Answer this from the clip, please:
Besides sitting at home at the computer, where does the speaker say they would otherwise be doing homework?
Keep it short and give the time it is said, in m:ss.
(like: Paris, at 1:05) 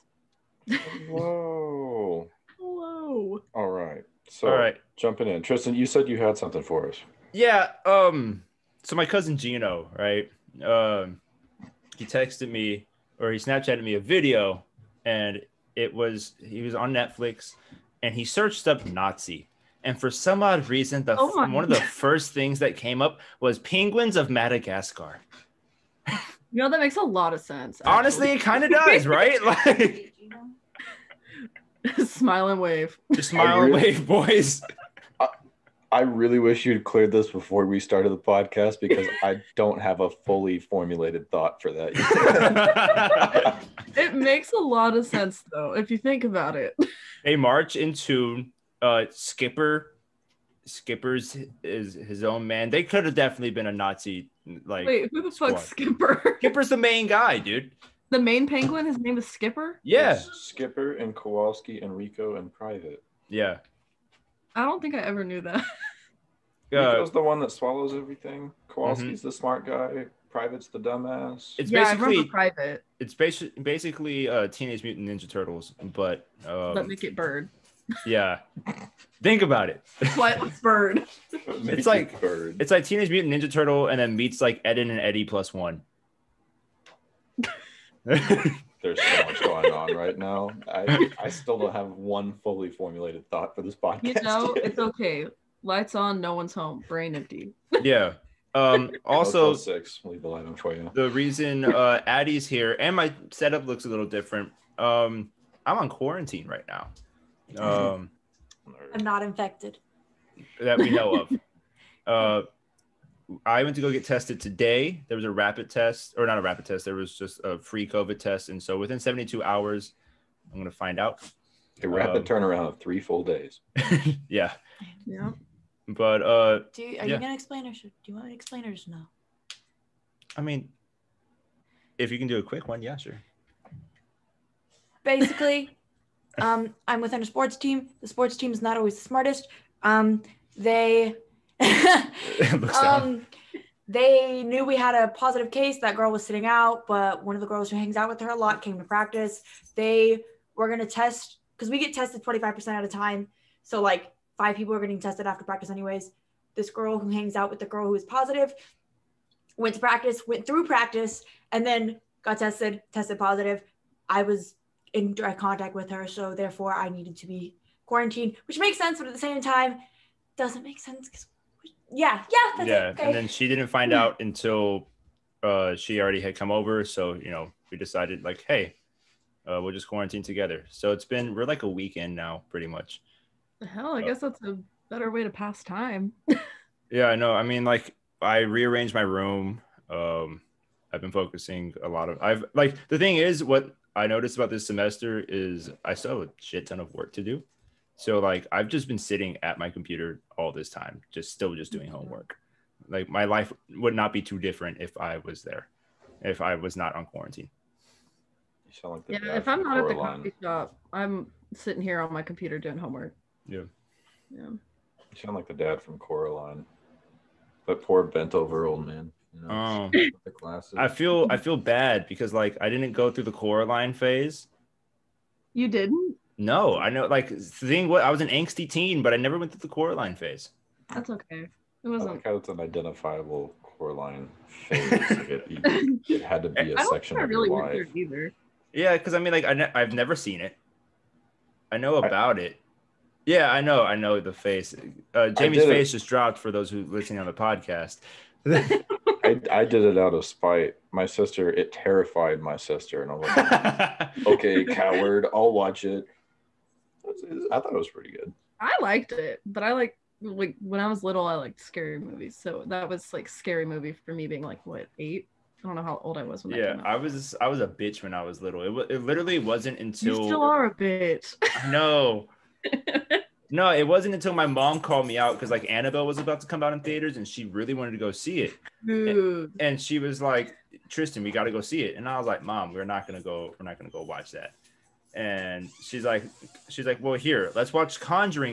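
Coffee shop, at 3:30.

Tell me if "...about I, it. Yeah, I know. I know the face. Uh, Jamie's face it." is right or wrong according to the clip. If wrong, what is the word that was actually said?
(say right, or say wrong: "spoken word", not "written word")
right.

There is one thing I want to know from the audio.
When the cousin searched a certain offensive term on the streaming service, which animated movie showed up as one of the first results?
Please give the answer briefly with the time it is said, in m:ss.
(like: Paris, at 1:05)
Penguins of Madagascar, at 0:23.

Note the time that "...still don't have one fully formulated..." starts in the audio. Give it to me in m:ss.
1:31.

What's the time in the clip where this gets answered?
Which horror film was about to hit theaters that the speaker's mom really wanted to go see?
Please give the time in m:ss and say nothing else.
4:35.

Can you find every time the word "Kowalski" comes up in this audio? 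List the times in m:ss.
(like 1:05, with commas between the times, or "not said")
1:01, 1:08.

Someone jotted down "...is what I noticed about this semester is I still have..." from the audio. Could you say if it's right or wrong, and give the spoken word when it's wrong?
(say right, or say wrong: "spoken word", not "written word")
right.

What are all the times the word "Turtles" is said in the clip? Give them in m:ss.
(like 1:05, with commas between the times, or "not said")
1:15, 1:23.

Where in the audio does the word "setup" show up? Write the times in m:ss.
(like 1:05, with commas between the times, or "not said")
1:43.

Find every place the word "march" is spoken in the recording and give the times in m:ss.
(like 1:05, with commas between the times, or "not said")
0:47.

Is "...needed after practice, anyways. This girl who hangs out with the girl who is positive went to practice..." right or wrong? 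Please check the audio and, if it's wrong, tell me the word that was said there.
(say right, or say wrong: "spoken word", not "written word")
wrong: "tested", not "needed".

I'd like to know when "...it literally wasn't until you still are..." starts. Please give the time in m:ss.
4:28.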